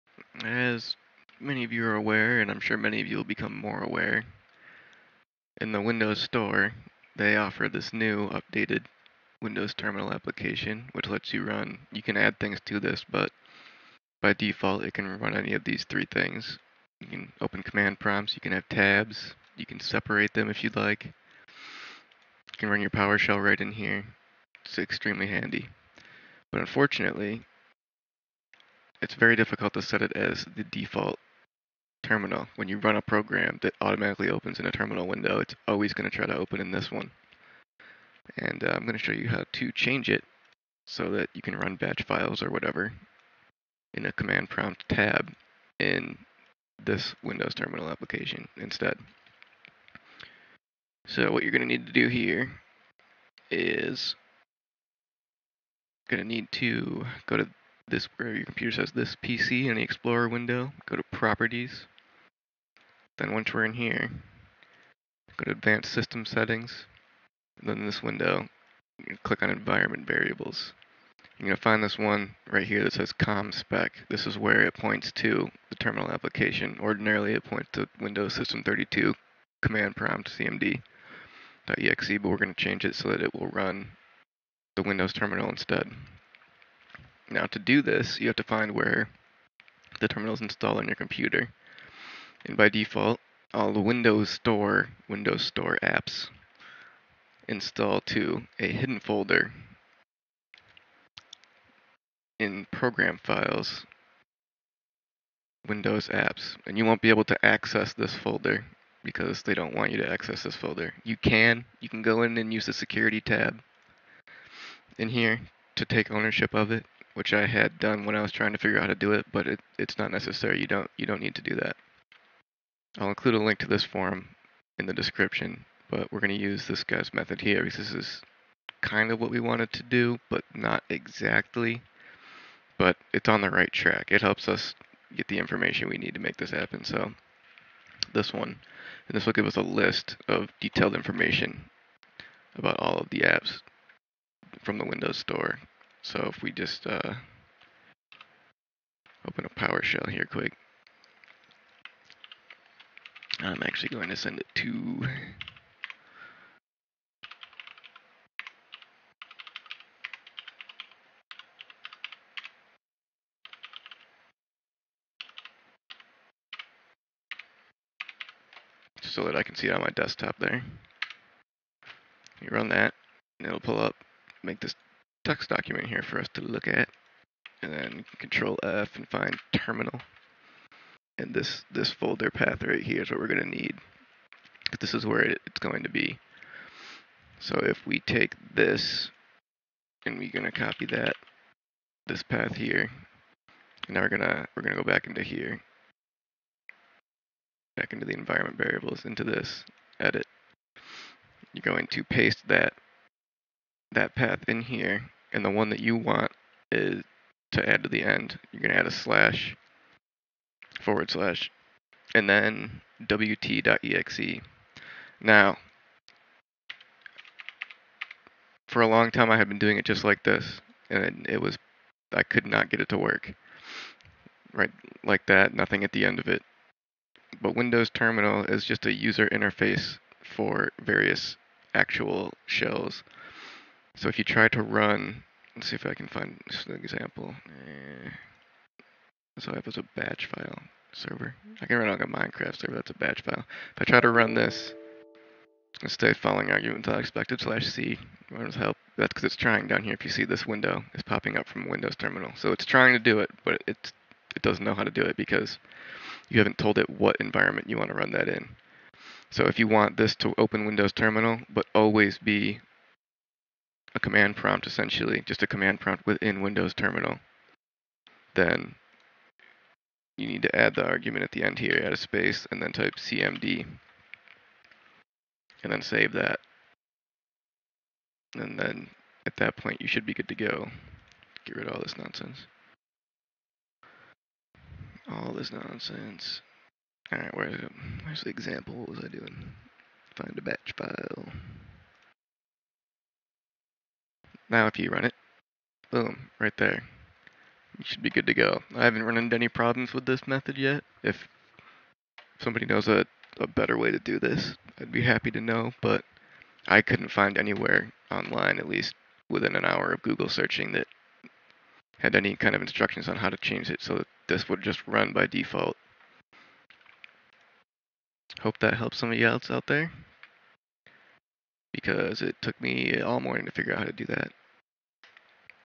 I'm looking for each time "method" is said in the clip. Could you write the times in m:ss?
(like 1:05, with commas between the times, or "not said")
2:07, 5:00.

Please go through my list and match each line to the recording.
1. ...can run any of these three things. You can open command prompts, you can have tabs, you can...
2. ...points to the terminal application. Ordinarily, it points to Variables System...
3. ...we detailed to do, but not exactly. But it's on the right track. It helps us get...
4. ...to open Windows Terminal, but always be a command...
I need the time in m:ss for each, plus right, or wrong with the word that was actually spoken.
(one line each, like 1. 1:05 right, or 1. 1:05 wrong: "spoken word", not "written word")
1. 0:14 right
2. 1:14 wrong: "Windows", not "Variables"
3. 2:09 wrong: "wanted", not "detailed"
4. 4:20 right.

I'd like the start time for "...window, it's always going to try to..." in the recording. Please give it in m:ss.
0:35.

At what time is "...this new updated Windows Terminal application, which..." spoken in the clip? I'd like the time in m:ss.
0:07.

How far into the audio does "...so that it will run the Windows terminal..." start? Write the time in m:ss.
1:22.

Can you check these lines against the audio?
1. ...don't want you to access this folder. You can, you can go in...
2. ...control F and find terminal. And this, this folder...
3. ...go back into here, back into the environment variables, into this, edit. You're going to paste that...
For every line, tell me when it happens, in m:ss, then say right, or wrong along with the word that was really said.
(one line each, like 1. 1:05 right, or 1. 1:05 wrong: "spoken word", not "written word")
1. 1:49 right
2. 2:58 right
3. 3:14 right.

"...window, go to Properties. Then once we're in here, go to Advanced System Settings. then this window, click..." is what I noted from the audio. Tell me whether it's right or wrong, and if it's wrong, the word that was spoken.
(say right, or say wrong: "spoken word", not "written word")
right.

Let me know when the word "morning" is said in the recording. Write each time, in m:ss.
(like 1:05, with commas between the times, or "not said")
5:23.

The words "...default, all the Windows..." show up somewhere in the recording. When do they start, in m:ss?
1:32.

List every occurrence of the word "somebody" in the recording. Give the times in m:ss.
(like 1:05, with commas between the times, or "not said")
5:02, 5:18.